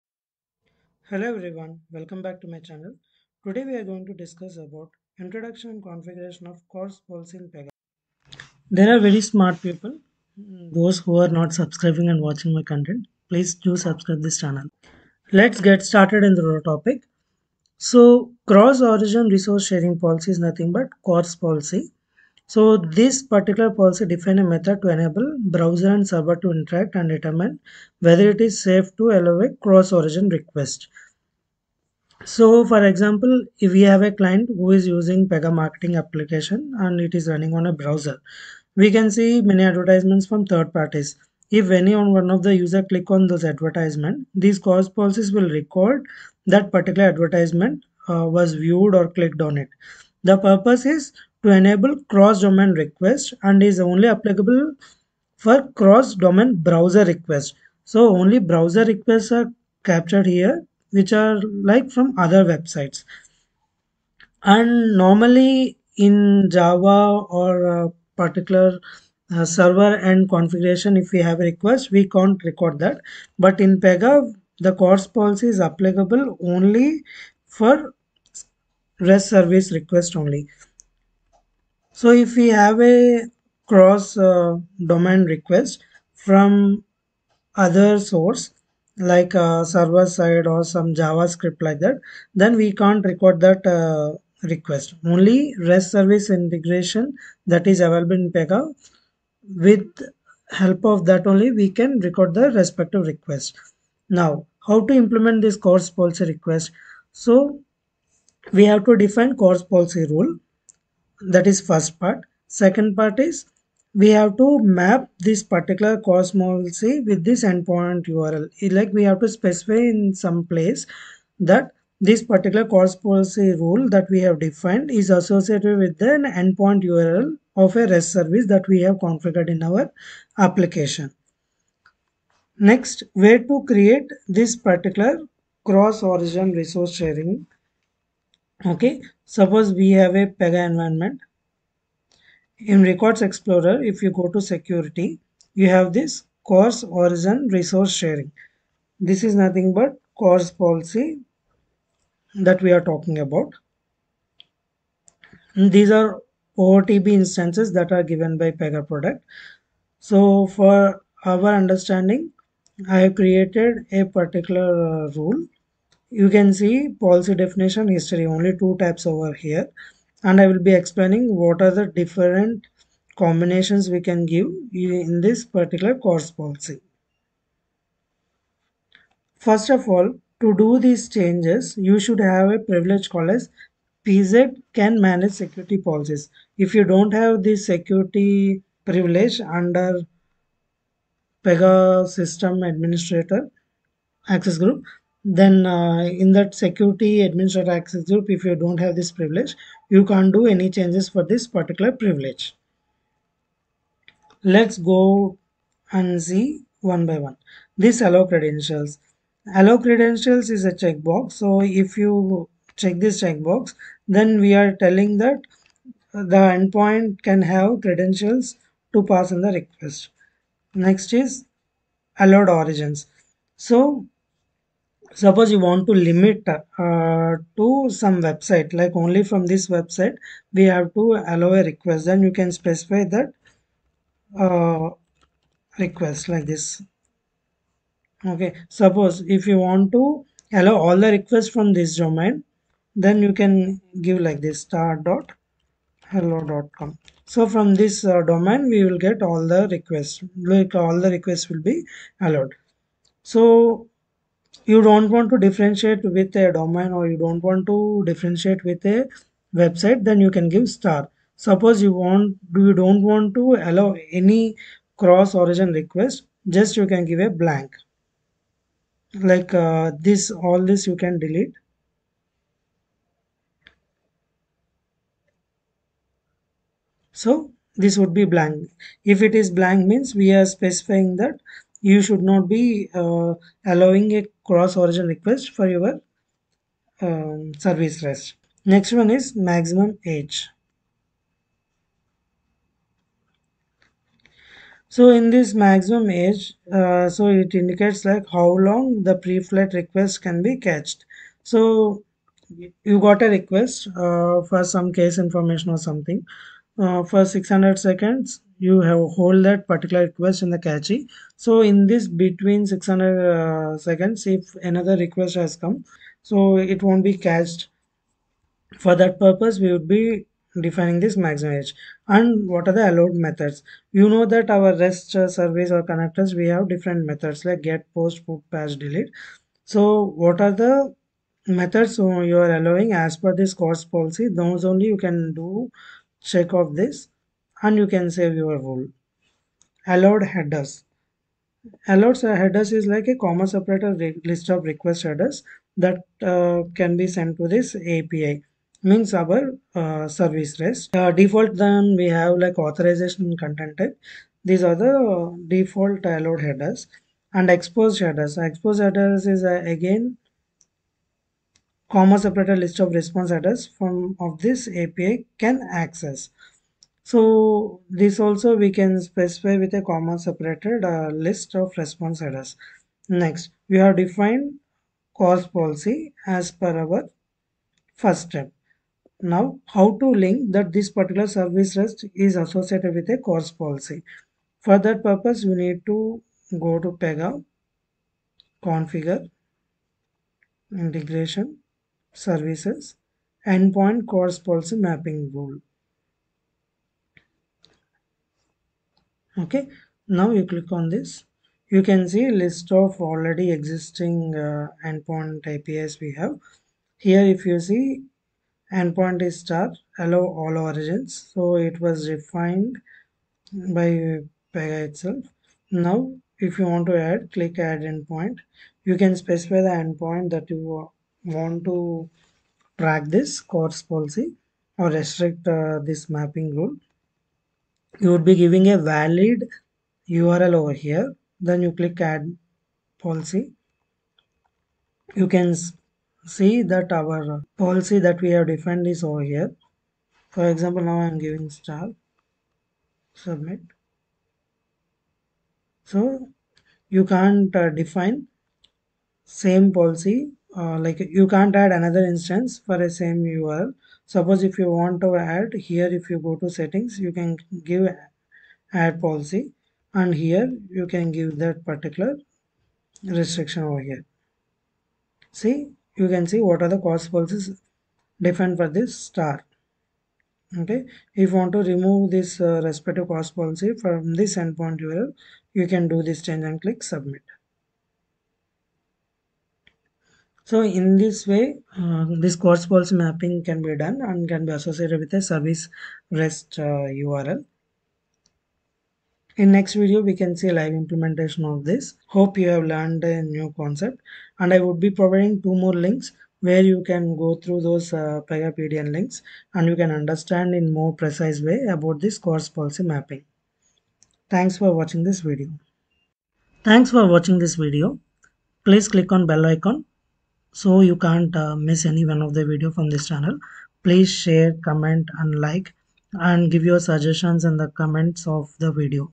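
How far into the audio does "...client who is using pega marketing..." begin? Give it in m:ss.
0:34.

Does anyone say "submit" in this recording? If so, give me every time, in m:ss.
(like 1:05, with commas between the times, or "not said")
7:23, 7:56.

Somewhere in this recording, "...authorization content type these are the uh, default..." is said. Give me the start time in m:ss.
5:52.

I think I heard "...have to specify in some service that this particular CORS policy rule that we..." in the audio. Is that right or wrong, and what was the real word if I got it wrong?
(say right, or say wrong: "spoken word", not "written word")
wrong: "place", not "service".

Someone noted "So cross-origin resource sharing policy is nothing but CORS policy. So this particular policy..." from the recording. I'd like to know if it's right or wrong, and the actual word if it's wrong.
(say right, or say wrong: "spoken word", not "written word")
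right.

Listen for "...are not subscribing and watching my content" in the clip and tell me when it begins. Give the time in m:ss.
0:11.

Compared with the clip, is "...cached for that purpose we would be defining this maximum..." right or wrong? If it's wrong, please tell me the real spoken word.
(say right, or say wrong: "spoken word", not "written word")
right.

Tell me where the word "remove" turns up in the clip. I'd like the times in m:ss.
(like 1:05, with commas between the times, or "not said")
7:51.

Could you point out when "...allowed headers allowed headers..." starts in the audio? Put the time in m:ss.
5:39.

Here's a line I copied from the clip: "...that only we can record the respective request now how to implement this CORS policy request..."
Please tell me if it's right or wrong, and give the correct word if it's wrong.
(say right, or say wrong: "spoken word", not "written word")
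right.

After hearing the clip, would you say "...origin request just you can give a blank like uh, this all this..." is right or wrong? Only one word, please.
right.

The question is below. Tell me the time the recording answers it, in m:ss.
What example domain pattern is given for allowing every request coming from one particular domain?
4:04.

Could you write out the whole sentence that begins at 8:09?
In next video, we can see live implementation of this.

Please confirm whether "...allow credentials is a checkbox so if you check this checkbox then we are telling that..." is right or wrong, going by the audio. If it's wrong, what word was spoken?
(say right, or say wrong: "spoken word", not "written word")
right.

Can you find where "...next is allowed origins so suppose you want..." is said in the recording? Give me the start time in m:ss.
3:40.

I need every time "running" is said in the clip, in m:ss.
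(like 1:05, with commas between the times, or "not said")
0:37.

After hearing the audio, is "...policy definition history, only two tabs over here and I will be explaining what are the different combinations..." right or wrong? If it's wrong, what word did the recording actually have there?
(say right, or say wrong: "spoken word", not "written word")
right.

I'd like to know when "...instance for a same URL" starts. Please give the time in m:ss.
7:32.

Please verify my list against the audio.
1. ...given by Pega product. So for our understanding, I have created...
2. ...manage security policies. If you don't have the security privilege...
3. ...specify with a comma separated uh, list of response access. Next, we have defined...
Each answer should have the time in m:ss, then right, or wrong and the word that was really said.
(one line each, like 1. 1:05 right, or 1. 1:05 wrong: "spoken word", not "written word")
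1. 2:38 right
2. 3:04 right
3. 6:09 wrong: "address", not "access".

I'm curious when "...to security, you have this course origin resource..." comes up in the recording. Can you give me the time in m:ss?
2:24.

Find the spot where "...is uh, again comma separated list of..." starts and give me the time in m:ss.
5:59.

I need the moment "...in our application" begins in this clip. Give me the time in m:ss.
2:09.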